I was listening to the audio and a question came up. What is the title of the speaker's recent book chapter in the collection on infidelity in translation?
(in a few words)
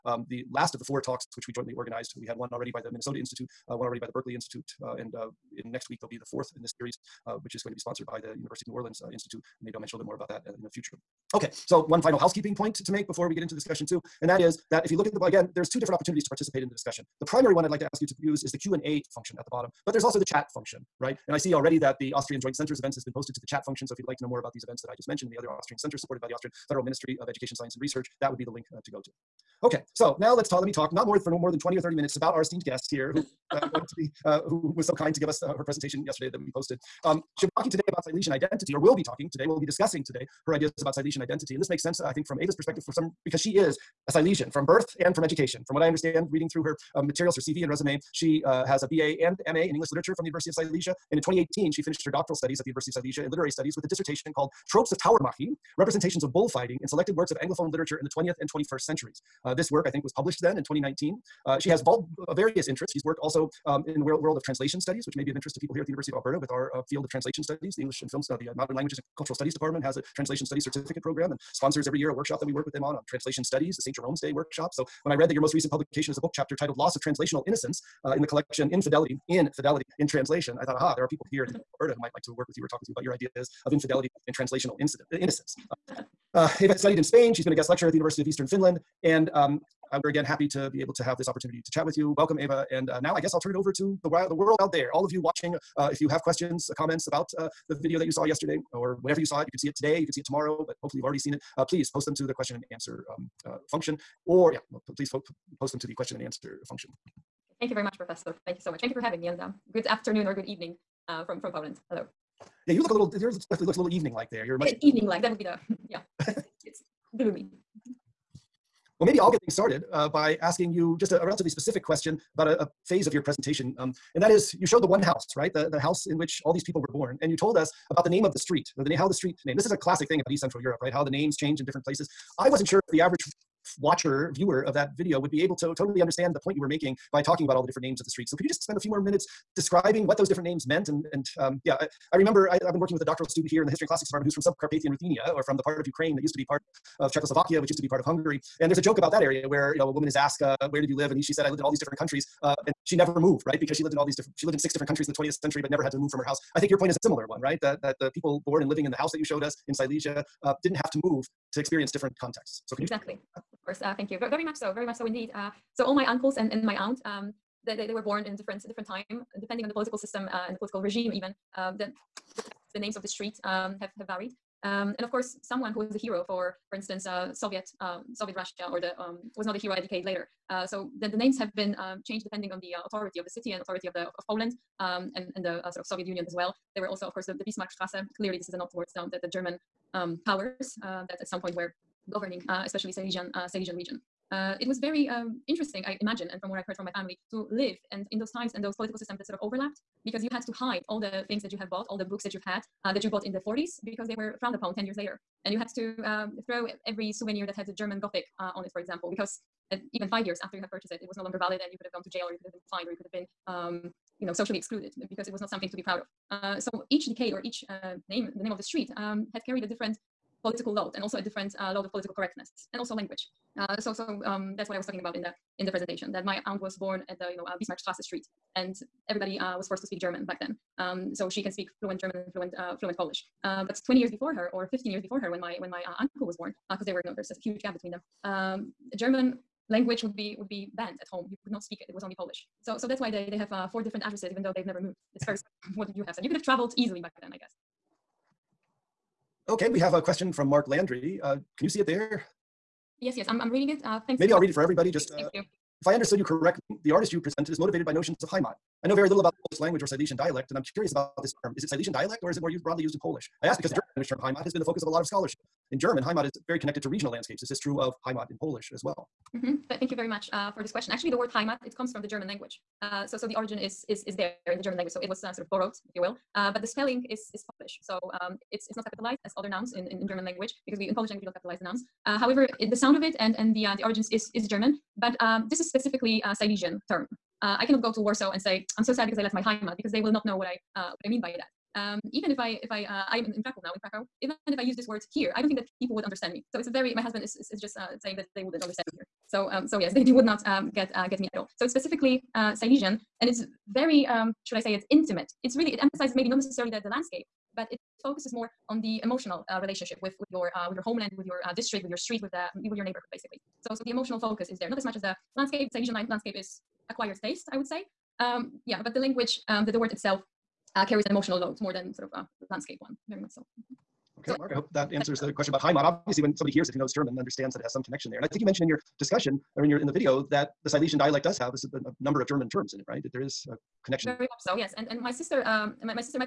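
Loss of Translational Innocence.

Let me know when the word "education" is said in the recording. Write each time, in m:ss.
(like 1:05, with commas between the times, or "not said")
0:27, 0:45.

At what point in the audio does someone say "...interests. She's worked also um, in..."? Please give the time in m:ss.
1:02.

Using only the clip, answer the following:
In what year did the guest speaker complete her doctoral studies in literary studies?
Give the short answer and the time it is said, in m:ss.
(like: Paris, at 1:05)
2018, at 0:51.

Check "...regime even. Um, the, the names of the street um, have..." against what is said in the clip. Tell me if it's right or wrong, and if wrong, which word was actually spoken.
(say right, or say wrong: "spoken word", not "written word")
right.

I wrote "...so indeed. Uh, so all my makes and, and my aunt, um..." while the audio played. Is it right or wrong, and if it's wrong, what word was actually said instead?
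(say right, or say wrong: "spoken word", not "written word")
wrong: "uncles", not "makes".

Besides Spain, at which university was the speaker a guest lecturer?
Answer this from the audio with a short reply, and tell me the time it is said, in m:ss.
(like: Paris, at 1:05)
University of Eastern Finland, at 1:27.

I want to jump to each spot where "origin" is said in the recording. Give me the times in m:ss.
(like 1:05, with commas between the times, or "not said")
4:33, 4:43.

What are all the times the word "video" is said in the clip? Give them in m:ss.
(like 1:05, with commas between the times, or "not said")
1:37, 2:14, 5:29.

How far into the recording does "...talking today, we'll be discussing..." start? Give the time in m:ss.
0:39.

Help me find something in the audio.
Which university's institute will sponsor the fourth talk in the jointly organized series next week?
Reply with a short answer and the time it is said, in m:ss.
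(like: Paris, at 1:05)
University of New Orleans, at 0:08.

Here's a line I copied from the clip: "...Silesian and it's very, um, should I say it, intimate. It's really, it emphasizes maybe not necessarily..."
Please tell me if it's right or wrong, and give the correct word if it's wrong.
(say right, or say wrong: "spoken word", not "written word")
right.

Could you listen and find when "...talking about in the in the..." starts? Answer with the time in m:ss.
3:44.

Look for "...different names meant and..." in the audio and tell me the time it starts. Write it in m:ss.
2:20.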